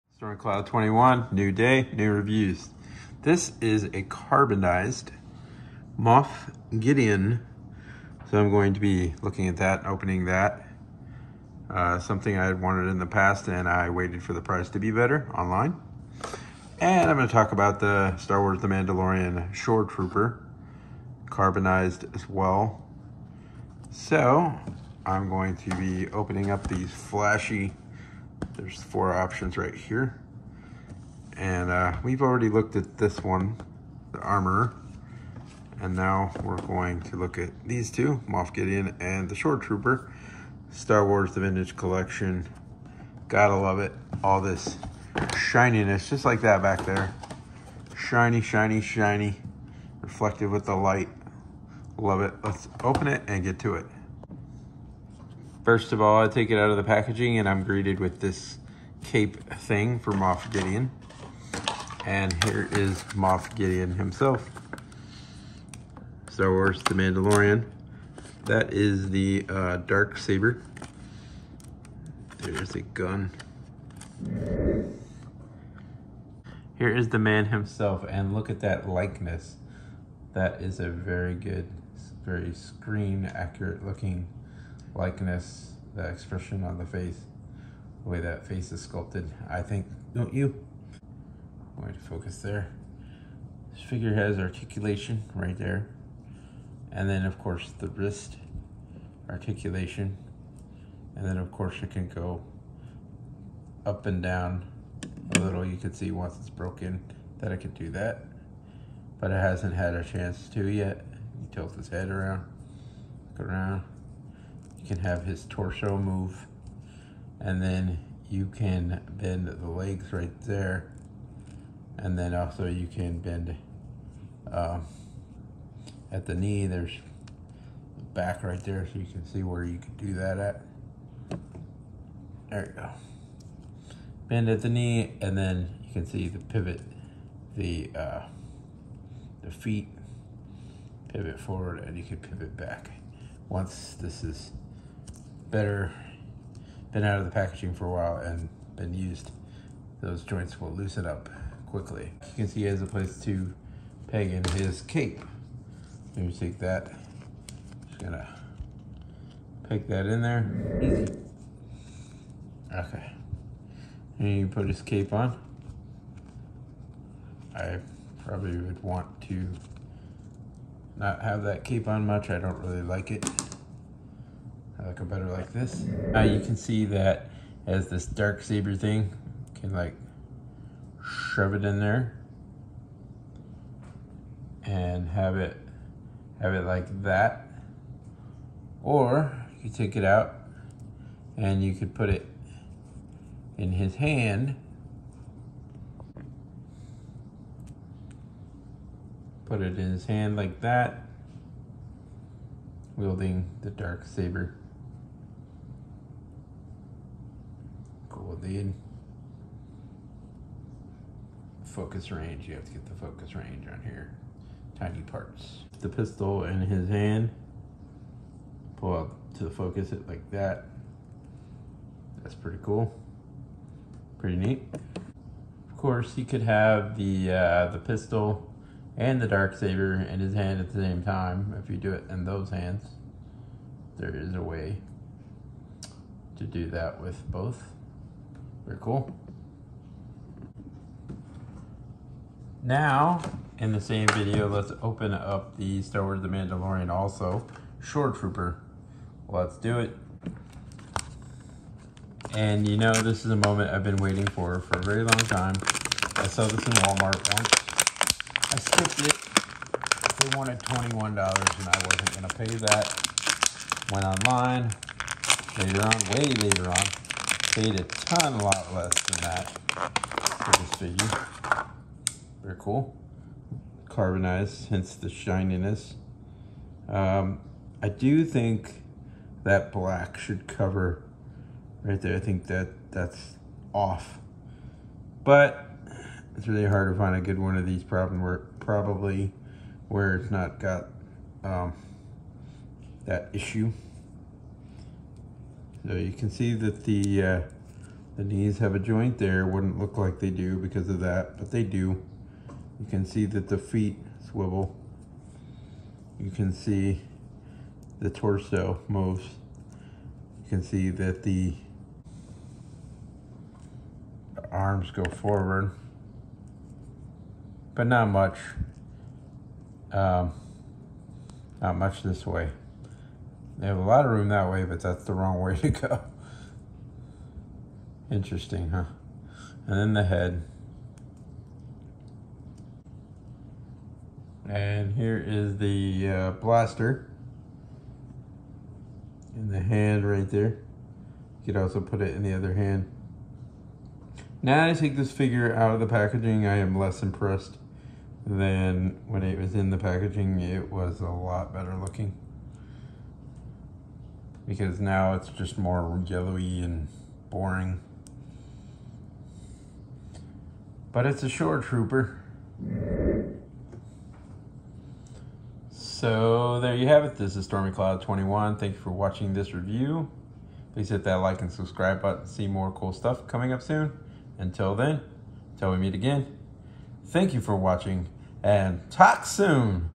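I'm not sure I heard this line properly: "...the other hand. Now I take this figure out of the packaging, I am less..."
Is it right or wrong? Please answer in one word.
right.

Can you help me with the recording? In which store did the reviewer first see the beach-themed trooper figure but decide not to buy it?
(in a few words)
Walmart.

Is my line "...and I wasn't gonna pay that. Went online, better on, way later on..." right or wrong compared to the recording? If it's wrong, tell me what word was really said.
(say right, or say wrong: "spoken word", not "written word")
wrong: "later", not "better".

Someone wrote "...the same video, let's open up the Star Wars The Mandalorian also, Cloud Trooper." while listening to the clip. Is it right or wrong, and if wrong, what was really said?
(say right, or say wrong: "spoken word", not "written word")
wrong: "Shore", not "Cloud".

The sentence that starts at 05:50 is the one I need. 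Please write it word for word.
It was a lot better looking because now it's just more yellowy and boring.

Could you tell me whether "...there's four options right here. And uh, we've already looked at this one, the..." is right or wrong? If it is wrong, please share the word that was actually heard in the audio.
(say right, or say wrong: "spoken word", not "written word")
right.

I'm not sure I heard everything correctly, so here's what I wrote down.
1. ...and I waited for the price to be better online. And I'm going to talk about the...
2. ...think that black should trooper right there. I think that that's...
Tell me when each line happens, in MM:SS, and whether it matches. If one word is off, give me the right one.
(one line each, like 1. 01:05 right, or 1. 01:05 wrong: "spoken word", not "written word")
1. 00:13 right
2. 04:38 wrong: "cover", not "trooper".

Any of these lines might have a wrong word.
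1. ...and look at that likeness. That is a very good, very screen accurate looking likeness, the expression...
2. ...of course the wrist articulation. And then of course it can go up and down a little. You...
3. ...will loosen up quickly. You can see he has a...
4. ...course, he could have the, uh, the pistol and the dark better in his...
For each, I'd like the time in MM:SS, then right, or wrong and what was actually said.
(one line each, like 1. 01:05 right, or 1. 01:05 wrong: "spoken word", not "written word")
1. 01:18 right
2. 01:37 right
3. 02:30 right
4. 03:45 wrong: "saber", not "better".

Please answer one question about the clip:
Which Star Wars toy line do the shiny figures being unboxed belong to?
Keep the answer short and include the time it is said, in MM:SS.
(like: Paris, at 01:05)
The Vintage Collection, at 00:40.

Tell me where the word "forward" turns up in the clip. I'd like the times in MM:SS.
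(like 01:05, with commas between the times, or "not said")
02:21, 05:15.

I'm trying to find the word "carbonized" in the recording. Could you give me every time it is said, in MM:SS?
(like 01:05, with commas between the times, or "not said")
00:04, 00:21, 04:33.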